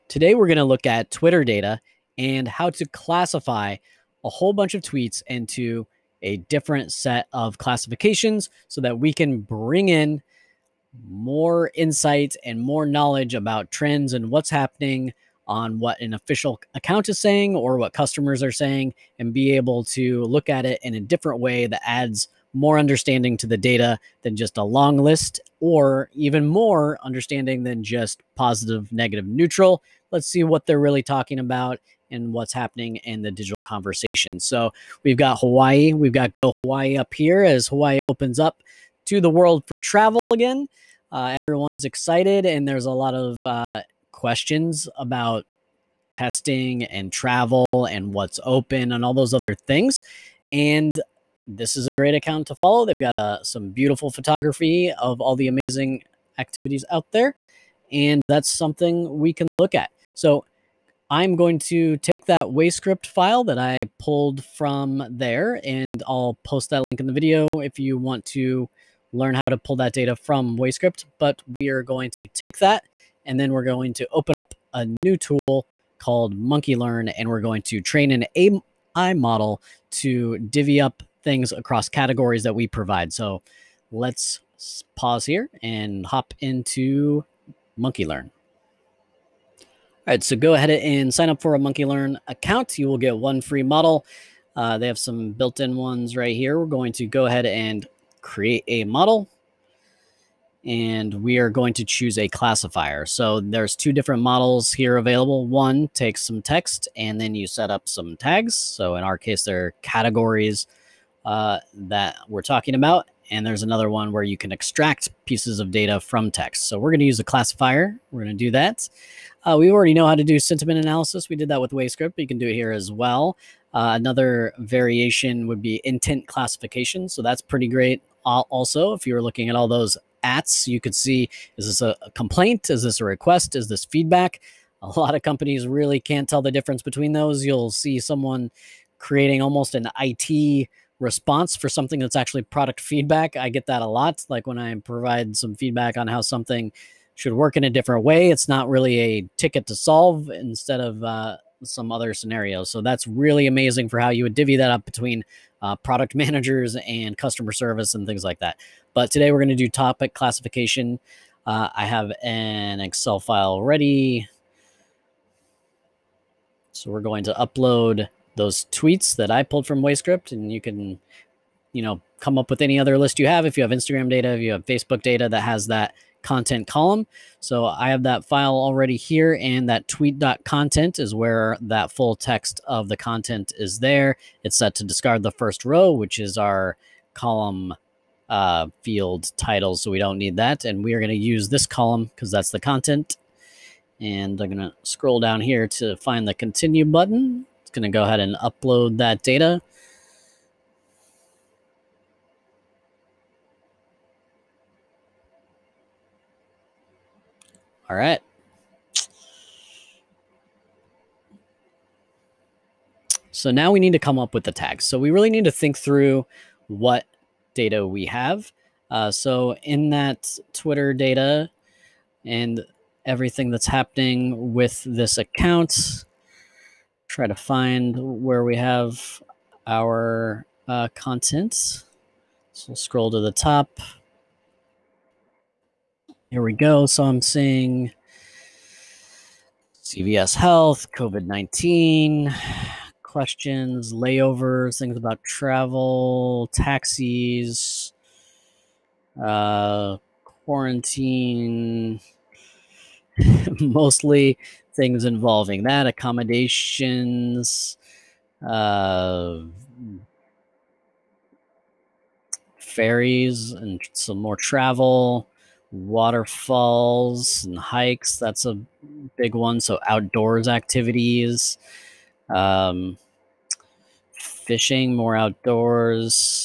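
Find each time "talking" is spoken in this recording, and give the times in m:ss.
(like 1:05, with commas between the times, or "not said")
0:31, 1:52.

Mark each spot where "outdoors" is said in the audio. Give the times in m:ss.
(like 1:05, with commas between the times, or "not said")
4:29, 4:35.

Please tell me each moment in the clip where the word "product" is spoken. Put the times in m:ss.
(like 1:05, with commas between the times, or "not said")
2:22, 2:35.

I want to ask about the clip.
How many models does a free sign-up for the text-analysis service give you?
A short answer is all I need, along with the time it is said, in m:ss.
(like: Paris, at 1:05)
1, at 1:33.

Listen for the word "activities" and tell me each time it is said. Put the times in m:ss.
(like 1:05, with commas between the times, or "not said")
0:56, 4:30.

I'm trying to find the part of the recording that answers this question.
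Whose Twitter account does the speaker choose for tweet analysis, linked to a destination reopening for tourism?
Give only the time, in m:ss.
0:36.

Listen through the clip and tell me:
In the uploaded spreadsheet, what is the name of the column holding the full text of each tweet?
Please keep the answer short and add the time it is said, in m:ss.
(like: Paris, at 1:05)
tweet.content, at 2:59.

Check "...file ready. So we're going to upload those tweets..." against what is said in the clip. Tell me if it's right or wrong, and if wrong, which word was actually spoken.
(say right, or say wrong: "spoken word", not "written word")
right.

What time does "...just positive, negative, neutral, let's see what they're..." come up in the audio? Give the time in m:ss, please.
0:27.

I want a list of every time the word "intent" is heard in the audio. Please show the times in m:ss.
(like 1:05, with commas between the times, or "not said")
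2:05.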